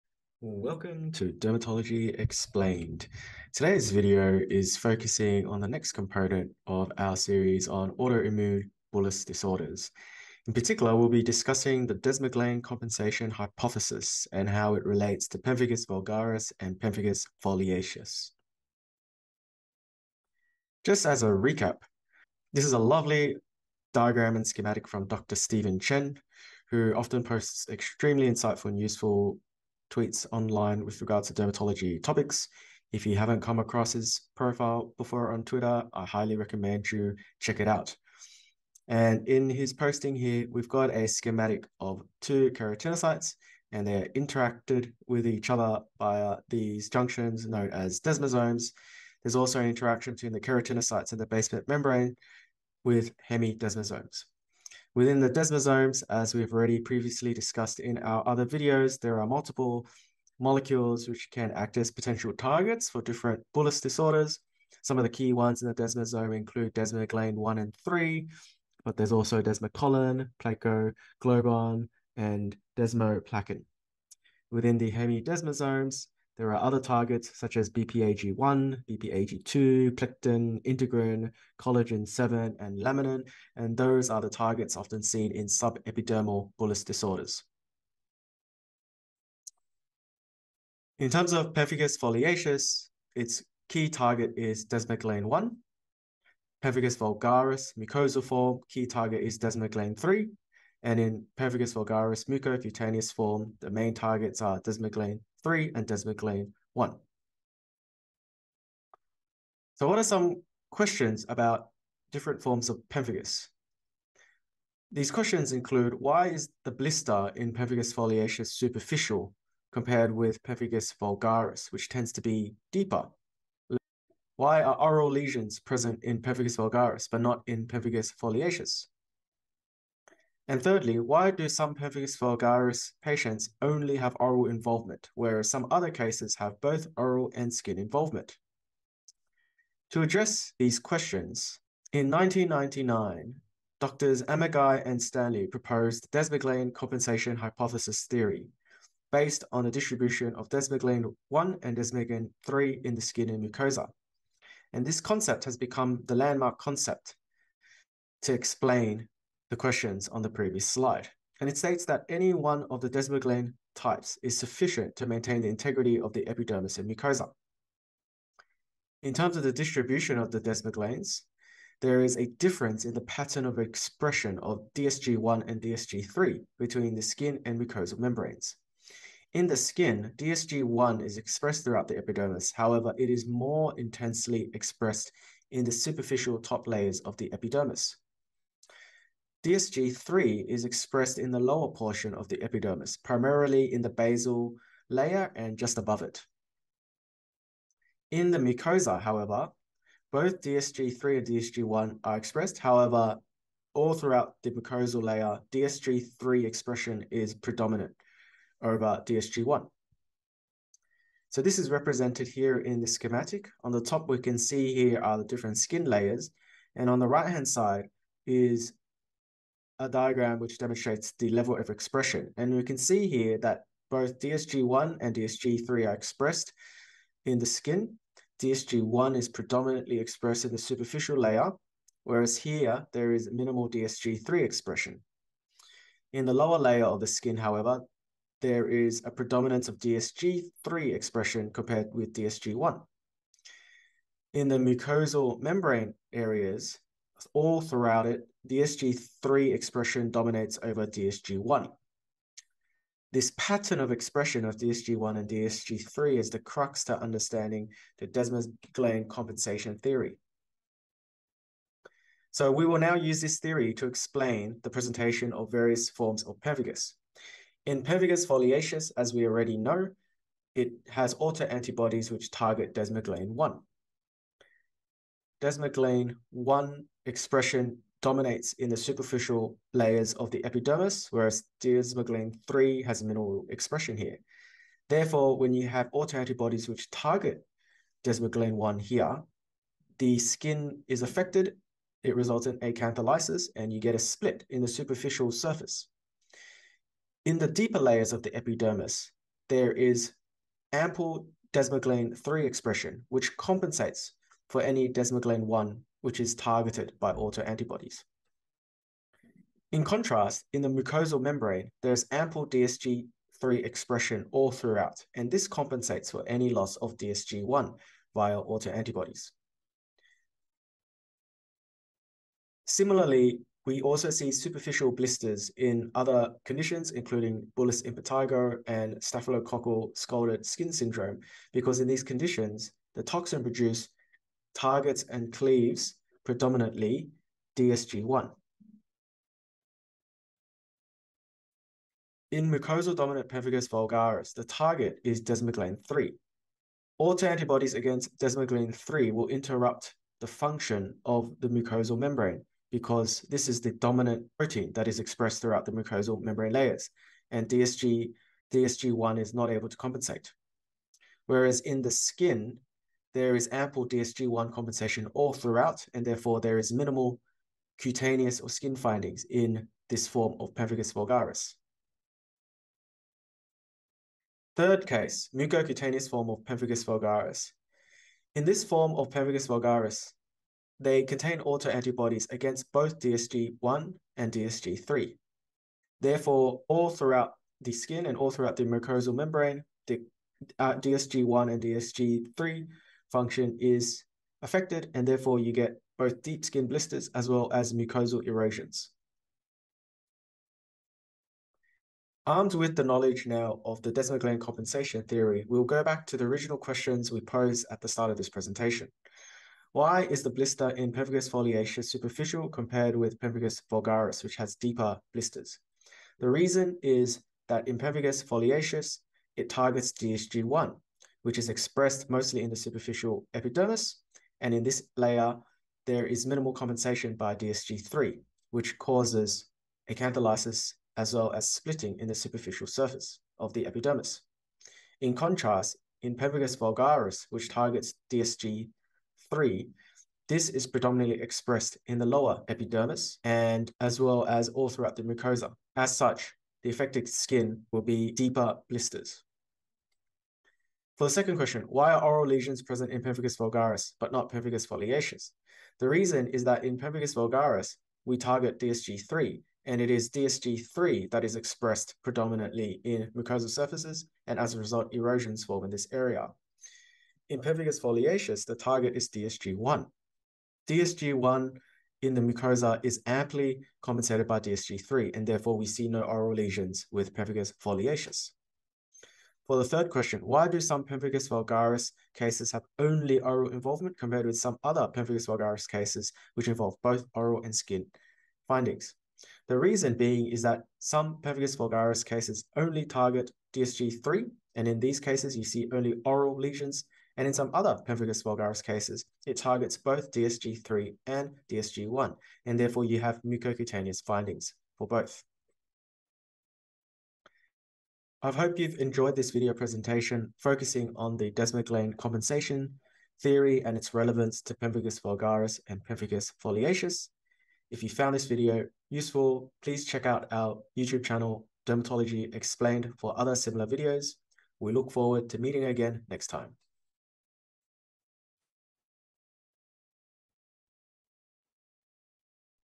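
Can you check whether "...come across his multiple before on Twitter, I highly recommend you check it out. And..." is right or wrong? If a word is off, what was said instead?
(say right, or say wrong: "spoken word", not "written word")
wrong: "profile", not "multiple".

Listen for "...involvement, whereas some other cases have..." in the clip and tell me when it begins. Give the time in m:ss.
2:14.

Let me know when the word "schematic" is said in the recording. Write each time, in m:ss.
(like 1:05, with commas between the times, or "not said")
0:24, 0:41, 3:32.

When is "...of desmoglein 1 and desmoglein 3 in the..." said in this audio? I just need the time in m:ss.
2:30.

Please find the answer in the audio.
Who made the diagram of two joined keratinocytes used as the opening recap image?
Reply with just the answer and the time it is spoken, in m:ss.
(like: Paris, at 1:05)
Dr. Stephen Chen, at 0:25.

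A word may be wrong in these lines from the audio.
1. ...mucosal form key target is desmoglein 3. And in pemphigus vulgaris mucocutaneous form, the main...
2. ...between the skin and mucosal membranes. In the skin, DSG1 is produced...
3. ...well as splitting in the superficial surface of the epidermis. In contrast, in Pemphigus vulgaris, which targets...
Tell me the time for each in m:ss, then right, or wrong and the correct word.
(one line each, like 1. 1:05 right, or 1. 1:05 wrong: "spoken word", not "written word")
1. 1:37 right
2. 2:56 wrong: "expressed", not "produced"
3. 7:11 right.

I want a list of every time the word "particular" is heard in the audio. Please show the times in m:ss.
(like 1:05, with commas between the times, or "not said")
0:10.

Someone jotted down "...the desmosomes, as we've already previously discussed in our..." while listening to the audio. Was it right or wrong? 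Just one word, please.
right.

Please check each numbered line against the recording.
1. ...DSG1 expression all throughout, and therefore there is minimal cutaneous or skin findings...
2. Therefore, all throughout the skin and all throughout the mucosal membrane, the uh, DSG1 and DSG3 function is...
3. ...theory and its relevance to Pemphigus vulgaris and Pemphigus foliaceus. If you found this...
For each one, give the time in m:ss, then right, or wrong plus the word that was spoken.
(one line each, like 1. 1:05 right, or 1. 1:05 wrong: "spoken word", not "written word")
1. 6:03 wrong: "compensation", not "expression"
2. 6:26 right
3. 8:33 right.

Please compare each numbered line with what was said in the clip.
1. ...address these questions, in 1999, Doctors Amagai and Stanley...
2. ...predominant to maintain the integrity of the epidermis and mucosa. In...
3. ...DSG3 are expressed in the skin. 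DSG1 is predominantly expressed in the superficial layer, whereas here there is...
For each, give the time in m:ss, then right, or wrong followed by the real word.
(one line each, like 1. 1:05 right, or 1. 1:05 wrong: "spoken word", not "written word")
1. 2:20 right
2. 2:44 wrong: "sufficient", not "predominant"
3. 3:45 right.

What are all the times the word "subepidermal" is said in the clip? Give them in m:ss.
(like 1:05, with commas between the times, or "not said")
1:25.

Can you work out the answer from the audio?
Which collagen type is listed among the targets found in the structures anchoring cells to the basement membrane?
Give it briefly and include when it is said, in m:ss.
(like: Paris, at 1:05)
Collagen 7, at 1:21.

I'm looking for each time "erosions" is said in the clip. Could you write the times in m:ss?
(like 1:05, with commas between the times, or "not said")
6:38, 7:44.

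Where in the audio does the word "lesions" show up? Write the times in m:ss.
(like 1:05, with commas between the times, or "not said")
2:05, 7:32, 7:56, 8:16.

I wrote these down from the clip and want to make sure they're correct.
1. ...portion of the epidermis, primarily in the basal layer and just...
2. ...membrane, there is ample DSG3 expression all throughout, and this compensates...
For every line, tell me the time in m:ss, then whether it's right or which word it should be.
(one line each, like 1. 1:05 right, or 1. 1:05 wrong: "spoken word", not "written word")
1. 3:11 right
2. 5:11 right.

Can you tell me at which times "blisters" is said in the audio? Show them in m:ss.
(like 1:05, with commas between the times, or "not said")
1:56, 5:24, 6:36, 6:50, 6:55, 7:28.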